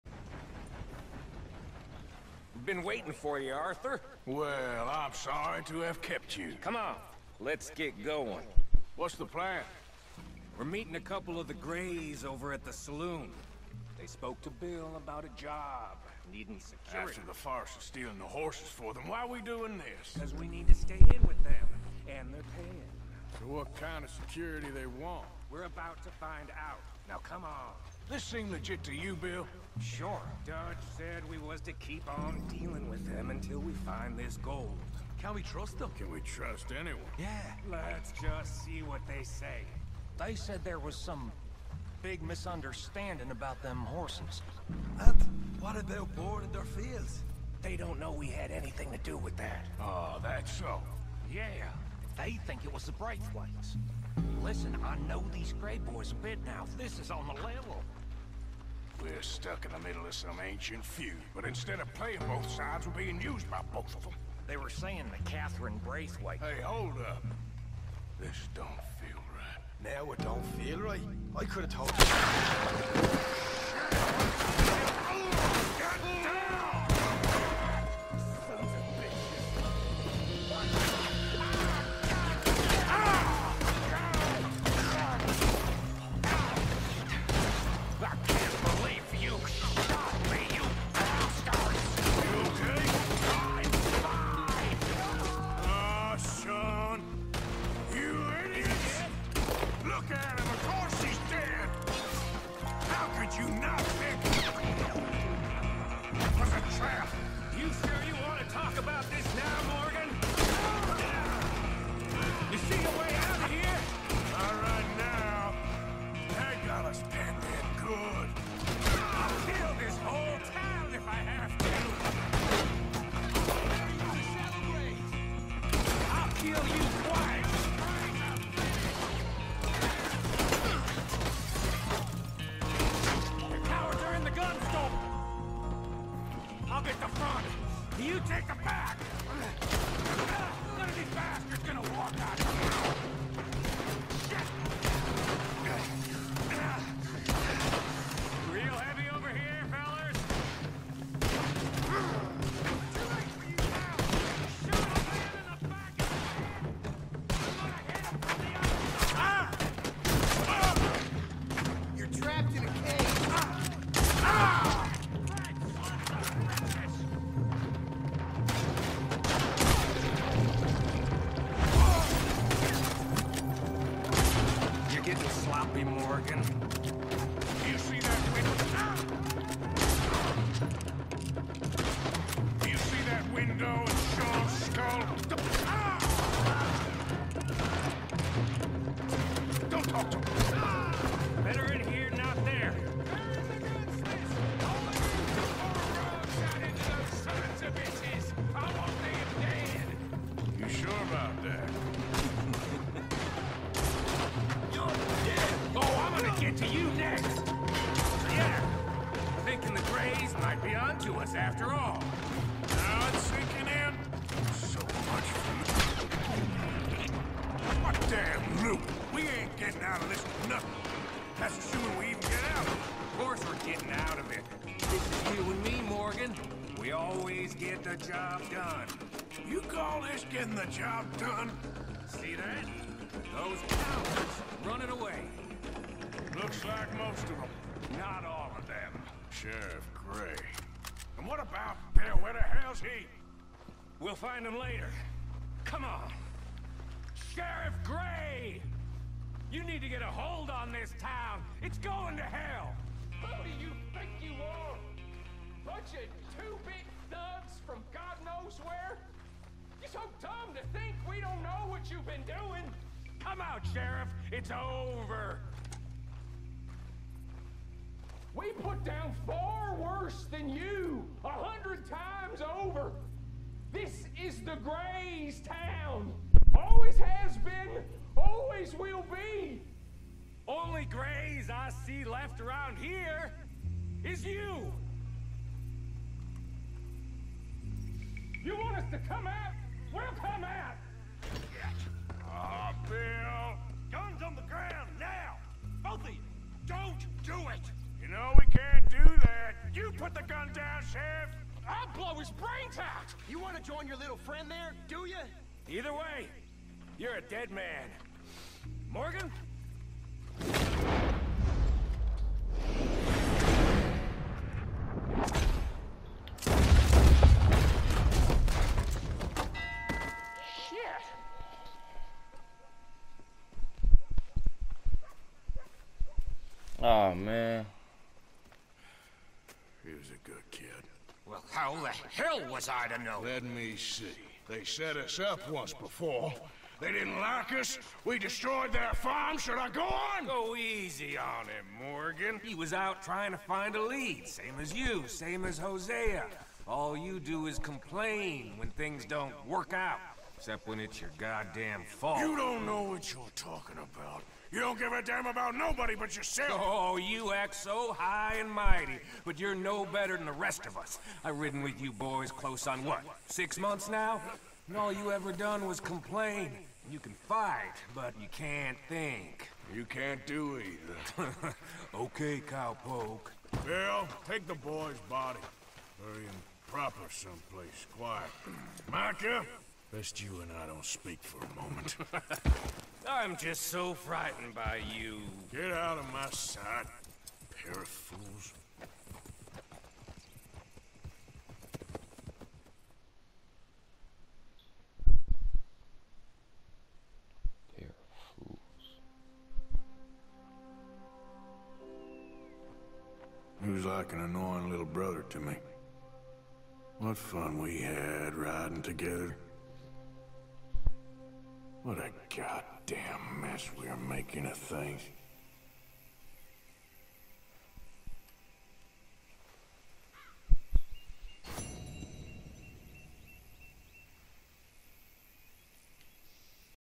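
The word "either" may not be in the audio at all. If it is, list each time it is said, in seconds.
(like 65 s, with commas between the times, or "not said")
305 s, 370 s.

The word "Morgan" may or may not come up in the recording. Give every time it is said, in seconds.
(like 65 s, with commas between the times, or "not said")
109 s, 175 s, 225 s, 308 s, 341 s.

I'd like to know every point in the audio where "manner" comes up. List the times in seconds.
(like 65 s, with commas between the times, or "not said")
not said.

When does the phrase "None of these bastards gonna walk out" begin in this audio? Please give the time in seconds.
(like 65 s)
140 s.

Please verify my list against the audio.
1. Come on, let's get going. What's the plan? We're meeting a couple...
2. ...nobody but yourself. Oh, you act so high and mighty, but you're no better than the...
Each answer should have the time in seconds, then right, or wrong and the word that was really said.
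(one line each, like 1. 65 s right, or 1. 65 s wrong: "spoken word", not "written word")
1. 6 s right
2. 355 s right.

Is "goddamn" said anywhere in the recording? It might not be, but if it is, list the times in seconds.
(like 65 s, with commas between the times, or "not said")
351 s, 412 s.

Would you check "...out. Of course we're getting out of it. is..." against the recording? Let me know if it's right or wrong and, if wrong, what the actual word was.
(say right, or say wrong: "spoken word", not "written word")
right.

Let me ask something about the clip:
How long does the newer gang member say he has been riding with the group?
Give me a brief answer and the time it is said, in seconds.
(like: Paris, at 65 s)
6 months, at 363 s.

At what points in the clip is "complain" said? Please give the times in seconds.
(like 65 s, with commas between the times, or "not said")
347 s, 365 s.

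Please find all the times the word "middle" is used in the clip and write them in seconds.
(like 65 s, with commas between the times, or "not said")
59 s.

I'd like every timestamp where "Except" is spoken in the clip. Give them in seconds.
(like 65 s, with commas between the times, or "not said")
350 s.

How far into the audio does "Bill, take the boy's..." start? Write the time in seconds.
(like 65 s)
373 s.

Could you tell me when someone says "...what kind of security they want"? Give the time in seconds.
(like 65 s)
23 s.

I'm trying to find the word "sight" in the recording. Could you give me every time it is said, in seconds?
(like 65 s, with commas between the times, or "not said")
386 s.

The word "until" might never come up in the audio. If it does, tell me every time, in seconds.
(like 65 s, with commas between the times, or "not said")
33 s.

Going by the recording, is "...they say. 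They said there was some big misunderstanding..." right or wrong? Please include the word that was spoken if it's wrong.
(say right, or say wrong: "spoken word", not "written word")
right.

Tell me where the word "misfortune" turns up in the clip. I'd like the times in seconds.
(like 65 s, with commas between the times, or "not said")
not said.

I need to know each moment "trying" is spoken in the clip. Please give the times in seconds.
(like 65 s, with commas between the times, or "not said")
343 s.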